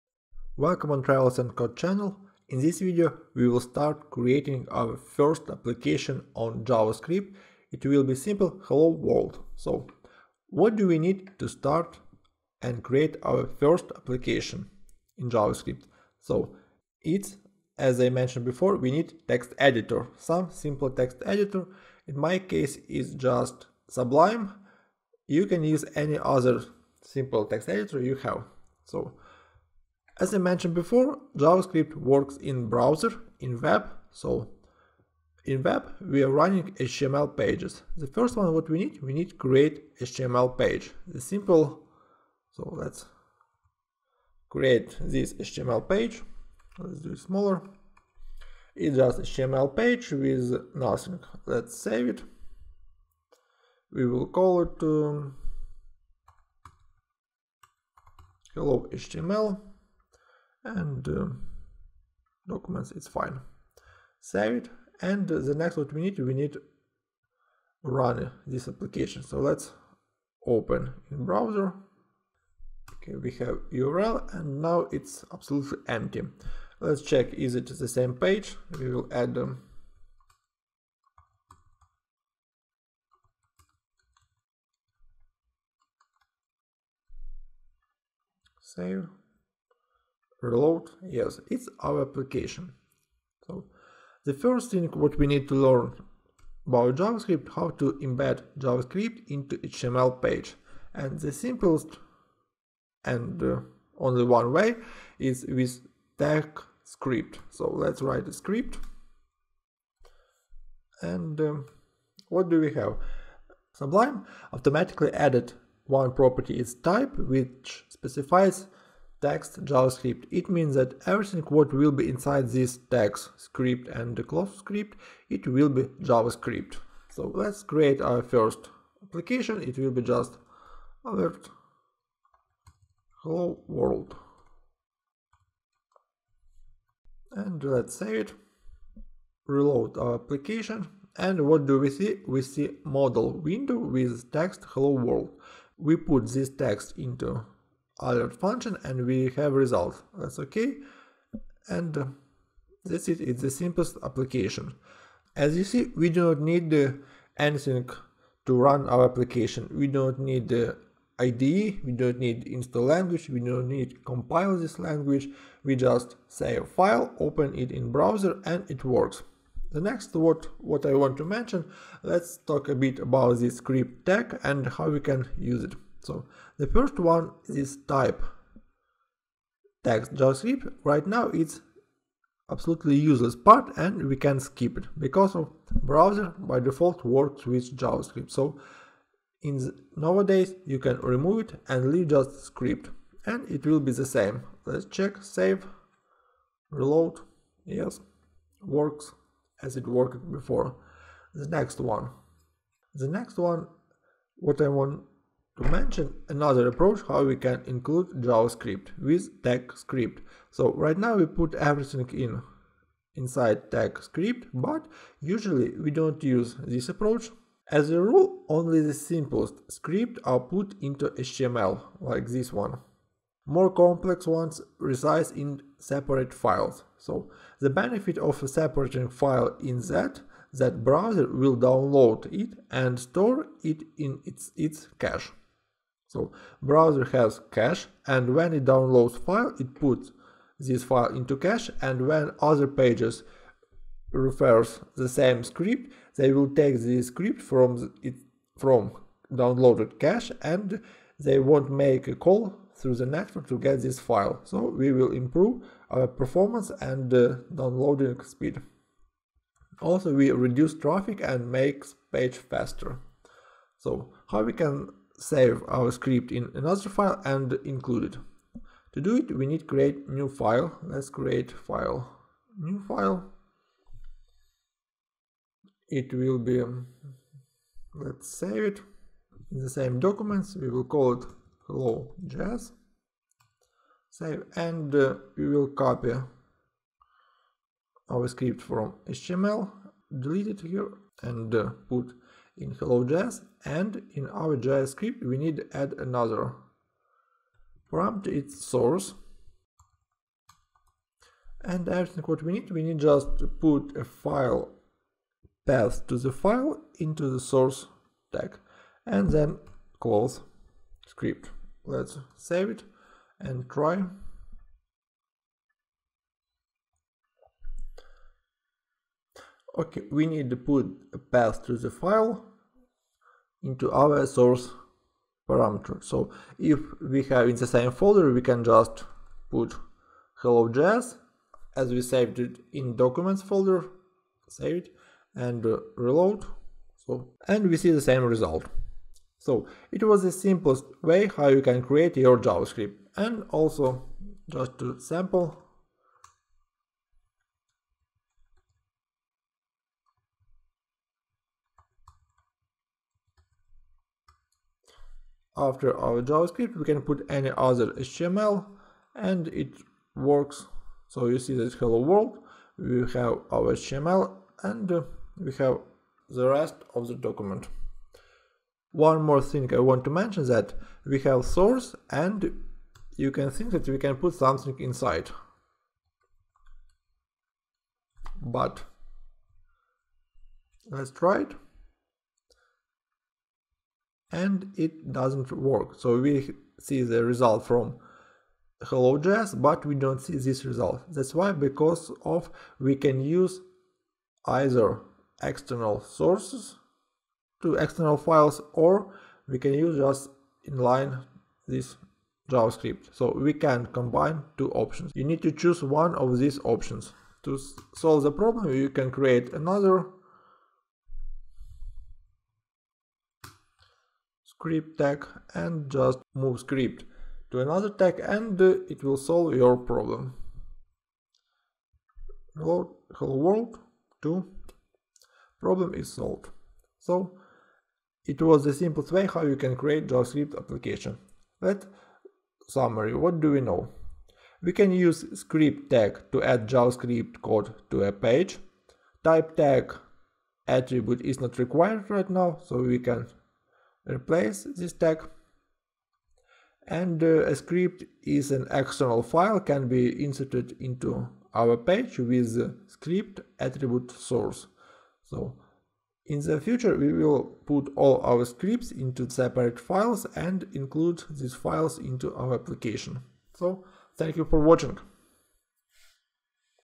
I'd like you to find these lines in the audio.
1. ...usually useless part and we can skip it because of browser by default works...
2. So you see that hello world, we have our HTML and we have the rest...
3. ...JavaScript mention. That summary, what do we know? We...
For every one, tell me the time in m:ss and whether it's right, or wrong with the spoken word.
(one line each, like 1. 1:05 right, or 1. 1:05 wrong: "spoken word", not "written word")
1. 3:02 wrong: "absolutely", not "usually"
2. 6:01 right
3. 7:10 wrong: "application", not "mention".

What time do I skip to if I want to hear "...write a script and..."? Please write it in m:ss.
1:48.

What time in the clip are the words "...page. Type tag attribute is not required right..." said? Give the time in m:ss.
7:18.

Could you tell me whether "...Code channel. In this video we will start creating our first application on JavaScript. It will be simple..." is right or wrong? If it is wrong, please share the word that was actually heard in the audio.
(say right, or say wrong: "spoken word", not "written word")
right.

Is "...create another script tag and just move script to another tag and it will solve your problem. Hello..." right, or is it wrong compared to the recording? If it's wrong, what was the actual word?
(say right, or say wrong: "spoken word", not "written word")
right.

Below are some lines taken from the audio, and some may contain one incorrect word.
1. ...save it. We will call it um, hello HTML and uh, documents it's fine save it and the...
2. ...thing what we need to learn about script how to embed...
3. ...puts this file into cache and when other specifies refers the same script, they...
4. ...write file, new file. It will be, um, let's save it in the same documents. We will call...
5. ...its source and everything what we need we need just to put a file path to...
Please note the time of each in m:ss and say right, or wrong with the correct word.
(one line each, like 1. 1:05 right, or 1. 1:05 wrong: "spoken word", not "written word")
1. 0:51 right
2. 1:34 wrong: "javascript", not "script"
3. 3:59 wrong: "pages", not "specifies"
4. 4:31 wrong: "create", not "write"
5. 4:58 right.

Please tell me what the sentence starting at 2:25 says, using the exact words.
We put this text into alert function and we have result.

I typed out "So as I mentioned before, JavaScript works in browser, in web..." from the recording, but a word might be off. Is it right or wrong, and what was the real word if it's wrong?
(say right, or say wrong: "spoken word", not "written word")
right.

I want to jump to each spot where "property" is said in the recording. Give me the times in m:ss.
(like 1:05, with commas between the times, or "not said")
1:56.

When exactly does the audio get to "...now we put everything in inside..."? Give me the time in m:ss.
3:30.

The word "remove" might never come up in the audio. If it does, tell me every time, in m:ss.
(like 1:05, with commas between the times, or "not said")
3:10.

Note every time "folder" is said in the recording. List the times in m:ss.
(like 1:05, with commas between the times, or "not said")
5:27, 5:33.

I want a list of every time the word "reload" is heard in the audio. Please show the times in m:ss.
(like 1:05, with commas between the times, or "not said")
1:30, 2:19, 3:16, 5:35.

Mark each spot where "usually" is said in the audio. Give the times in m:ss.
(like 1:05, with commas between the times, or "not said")
3:35.